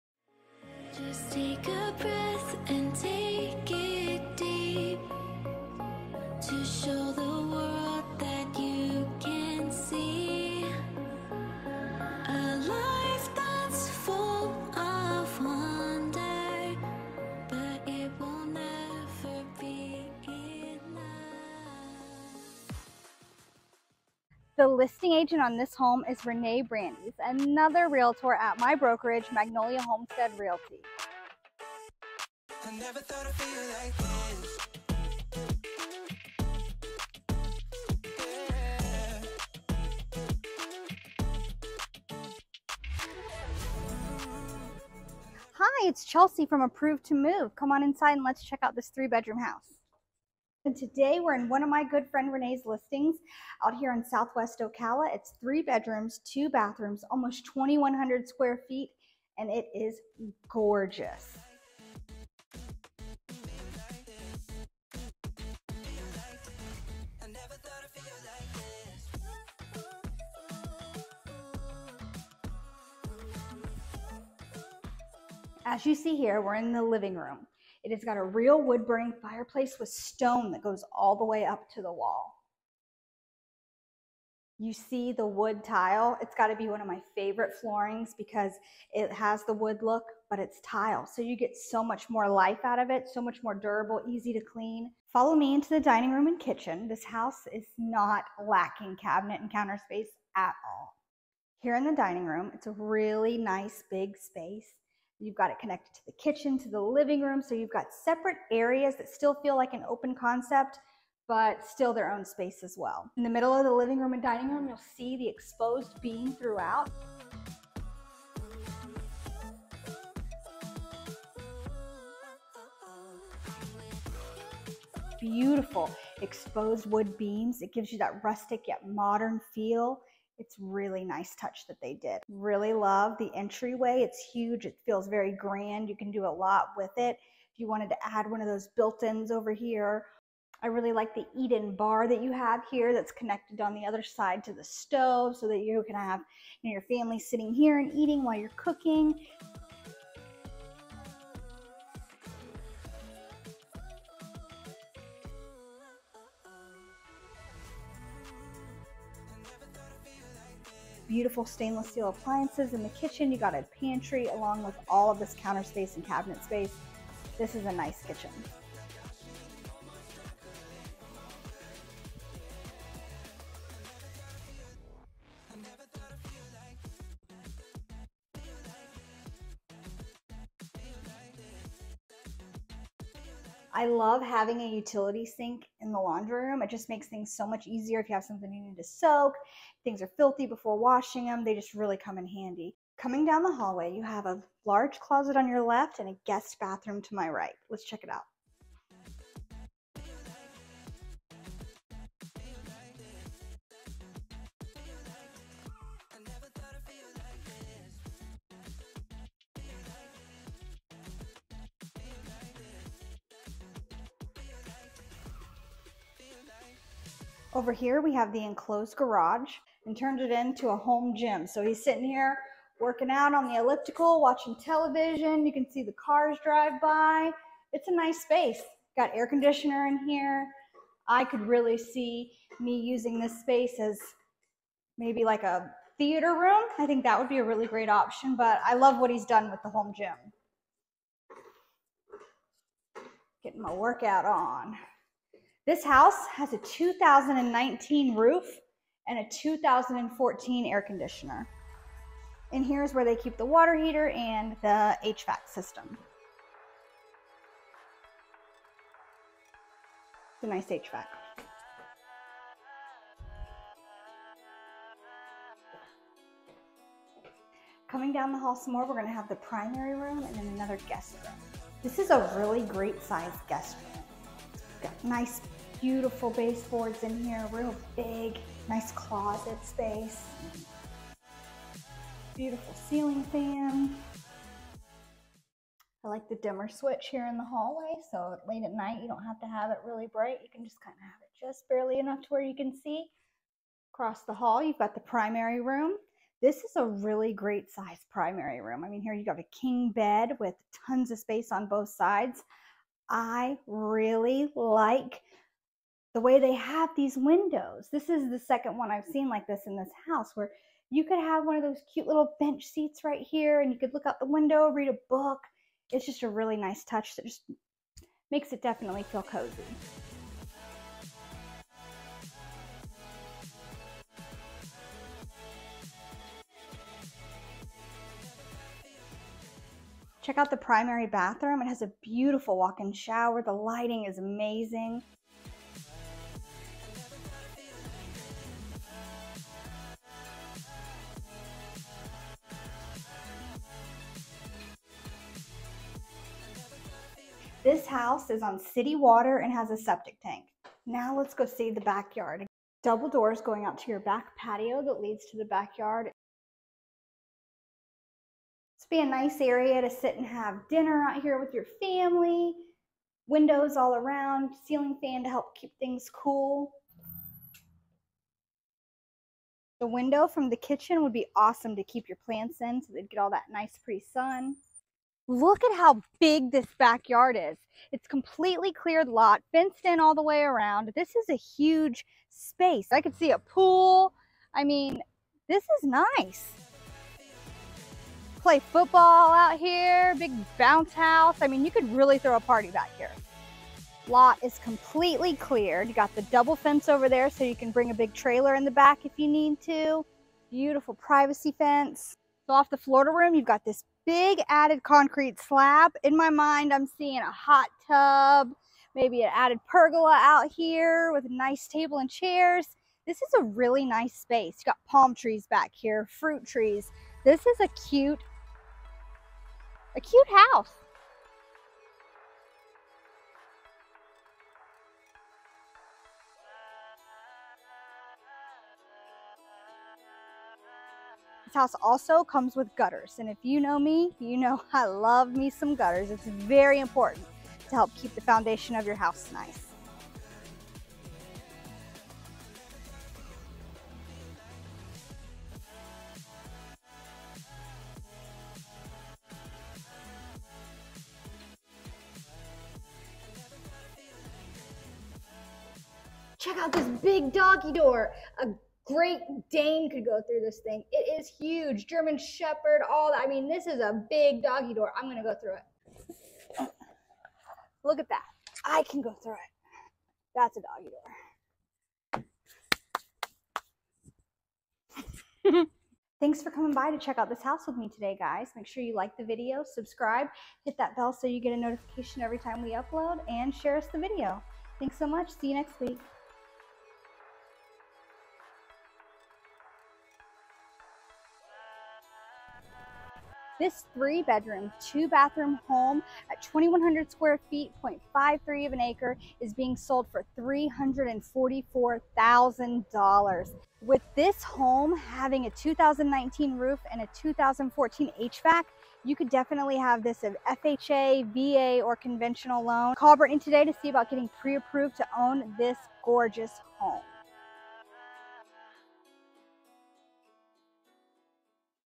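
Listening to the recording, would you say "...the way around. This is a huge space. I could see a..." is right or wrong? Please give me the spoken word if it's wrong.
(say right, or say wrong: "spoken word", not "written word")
right.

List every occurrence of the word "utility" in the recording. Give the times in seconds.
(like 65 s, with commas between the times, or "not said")
184 s.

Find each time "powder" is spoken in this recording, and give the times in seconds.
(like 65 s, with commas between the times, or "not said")
not said.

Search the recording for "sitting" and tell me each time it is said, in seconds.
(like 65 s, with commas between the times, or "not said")
147 s, 221 s.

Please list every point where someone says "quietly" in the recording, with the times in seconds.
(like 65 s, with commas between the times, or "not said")
not said.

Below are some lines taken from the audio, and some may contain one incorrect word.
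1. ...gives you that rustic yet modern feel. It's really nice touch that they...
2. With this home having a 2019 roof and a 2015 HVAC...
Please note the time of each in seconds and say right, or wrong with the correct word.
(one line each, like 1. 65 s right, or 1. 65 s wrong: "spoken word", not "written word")
1. 127 s right
2. 503 s wrong: "2014", not "2015".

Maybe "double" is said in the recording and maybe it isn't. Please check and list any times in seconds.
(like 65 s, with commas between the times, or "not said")
352 s, 396 s.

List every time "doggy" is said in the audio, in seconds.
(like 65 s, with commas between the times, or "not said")
457 s, 464 s, 472 s.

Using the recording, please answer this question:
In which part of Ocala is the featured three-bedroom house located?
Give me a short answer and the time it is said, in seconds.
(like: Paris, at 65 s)
Southwest Ocala, at 54 s.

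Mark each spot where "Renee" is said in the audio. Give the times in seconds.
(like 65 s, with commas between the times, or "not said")
26 s, 52 s.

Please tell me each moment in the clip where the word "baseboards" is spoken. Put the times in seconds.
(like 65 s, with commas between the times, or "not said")
276 s.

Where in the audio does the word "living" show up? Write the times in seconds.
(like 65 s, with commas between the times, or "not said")
76 s, 106 s, 113 s.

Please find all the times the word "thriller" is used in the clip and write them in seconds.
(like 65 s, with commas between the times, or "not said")
not said.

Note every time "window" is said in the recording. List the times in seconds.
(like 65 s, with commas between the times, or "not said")
307 s, 314 s, 363 s, 369 s.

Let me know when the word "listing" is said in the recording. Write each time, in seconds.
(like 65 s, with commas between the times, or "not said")
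24 s, 52 s.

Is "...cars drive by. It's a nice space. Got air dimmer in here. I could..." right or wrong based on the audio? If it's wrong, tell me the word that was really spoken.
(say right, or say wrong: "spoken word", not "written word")
wrong: "conditioner", not "dimmer".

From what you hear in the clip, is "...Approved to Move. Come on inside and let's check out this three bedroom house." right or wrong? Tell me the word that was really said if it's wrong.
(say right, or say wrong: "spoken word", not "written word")
right.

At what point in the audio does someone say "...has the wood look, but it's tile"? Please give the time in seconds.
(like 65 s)
89 s.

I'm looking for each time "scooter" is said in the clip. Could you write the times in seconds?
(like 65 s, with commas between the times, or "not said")
not said.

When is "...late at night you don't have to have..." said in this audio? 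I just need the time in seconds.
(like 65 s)
288 s.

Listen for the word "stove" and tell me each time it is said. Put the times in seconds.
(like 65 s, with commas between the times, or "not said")
144 s.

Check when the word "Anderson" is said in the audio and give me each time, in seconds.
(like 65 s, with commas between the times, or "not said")
not said.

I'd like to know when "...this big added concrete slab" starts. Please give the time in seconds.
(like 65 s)
403 s.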